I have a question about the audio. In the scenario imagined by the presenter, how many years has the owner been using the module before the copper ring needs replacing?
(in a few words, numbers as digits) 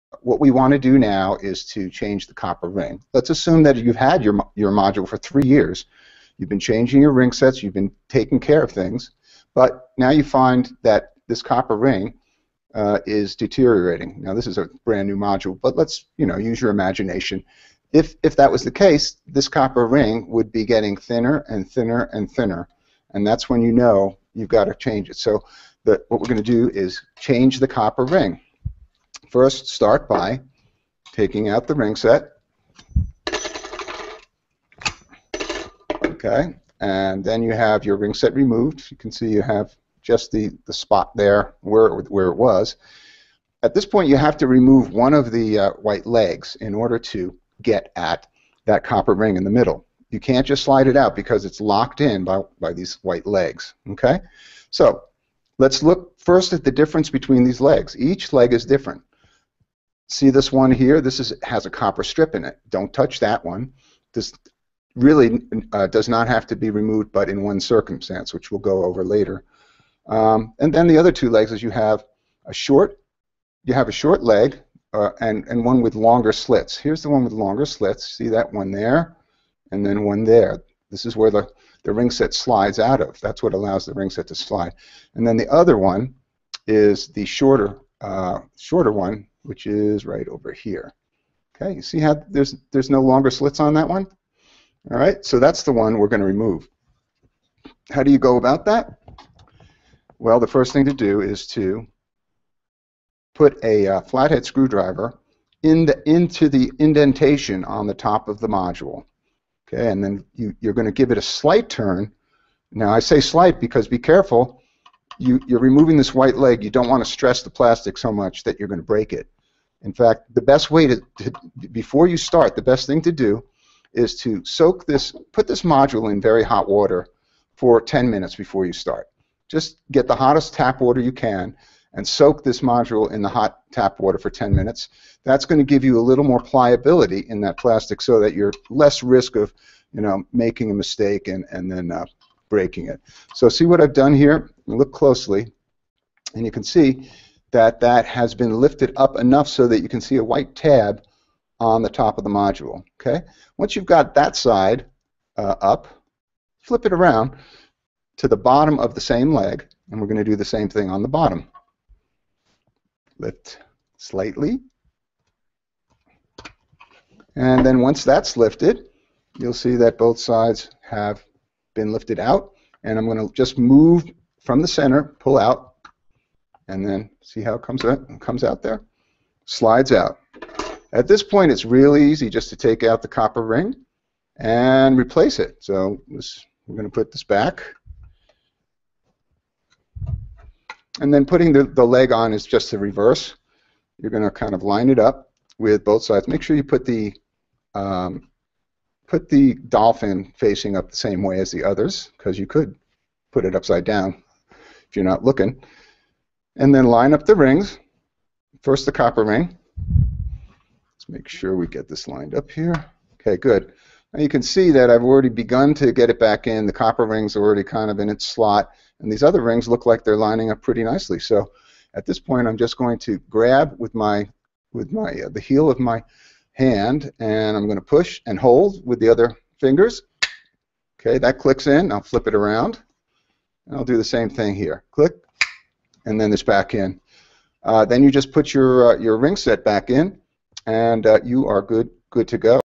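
3.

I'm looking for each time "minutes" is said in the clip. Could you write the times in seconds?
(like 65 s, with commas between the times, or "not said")
128 s, 134 s.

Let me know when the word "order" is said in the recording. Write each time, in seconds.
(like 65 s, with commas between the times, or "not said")
46 s.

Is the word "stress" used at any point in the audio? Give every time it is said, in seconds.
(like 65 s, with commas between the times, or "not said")
117 s.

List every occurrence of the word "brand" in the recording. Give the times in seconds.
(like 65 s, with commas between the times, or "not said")
14 s.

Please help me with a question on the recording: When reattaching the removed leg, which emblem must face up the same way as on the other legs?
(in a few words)
dolphin.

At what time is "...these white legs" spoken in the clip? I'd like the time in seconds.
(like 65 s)
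52 s.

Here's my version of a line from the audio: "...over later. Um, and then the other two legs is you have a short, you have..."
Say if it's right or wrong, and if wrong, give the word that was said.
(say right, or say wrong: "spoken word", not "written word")
right.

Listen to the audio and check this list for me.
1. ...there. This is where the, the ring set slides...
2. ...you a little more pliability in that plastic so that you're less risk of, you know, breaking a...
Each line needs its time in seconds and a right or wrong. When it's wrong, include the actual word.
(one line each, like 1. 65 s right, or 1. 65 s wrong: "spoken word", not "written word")
1. 80 s right
2. 135 s wrong: "making", not "breaking".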